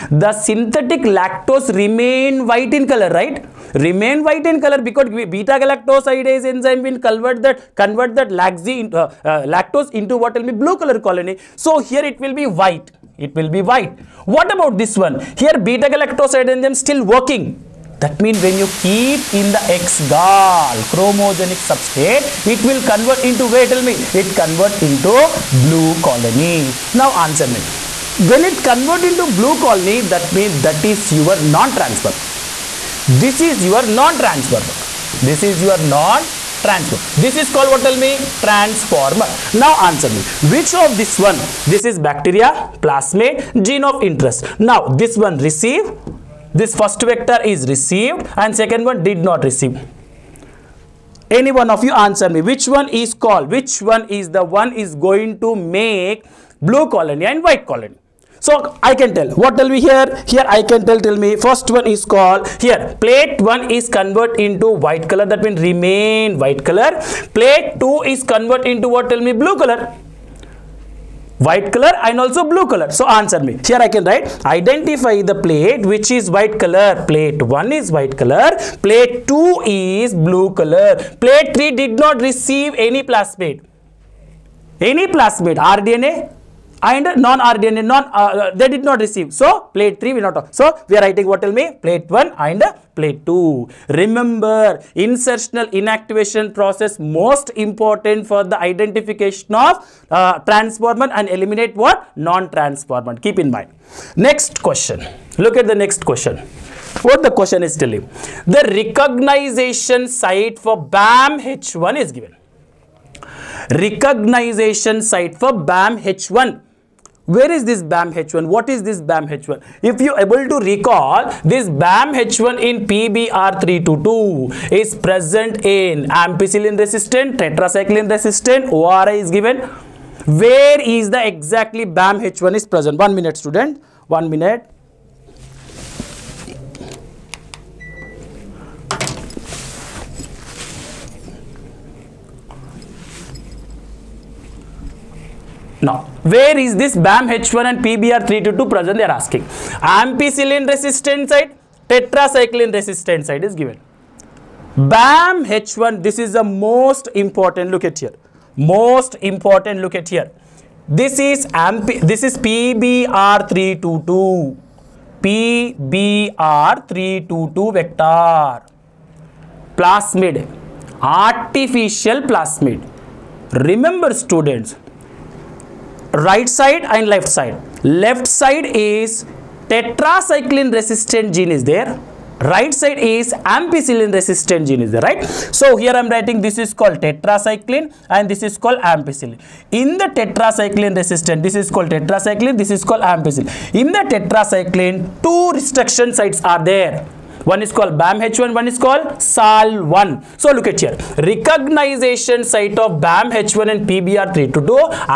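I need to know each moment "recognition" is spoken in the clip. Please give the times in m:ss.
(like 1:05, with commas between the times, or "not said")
1:48, 1:53, 3:21.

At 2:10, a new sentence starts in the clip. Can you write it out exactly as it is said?
Where is the exactly BAMH1 is present?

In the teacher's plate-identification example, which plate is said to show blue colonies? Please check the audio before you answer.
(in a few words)
Plate 2.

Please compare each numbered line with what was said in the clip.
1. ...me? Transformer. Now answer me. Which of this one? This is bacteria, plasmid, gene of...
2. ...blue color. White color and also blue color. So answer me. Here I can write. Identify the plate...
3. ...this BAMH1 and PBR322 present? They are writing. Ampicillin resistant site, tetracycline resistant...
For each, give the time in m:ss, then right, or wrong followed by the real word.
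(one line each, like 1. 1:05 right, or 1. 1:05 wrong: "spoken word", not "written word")
1. 0:37 right
2. 1:09 right
3. 2:26 wrong: "asking", not "writing".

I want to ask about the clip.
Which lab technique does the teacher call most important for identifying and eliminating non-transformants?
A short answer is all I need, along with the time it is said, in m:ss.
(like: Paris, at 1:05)
Insertional inactivation, at 1:34.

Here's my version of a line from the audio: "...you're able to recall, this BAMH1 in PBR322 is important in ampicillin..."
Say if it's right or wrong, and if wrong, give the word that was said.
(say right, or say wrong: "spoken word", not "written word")
wrong: "present", not "important".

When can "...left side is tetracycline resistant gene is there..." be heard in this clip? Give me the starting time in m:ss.
2:57.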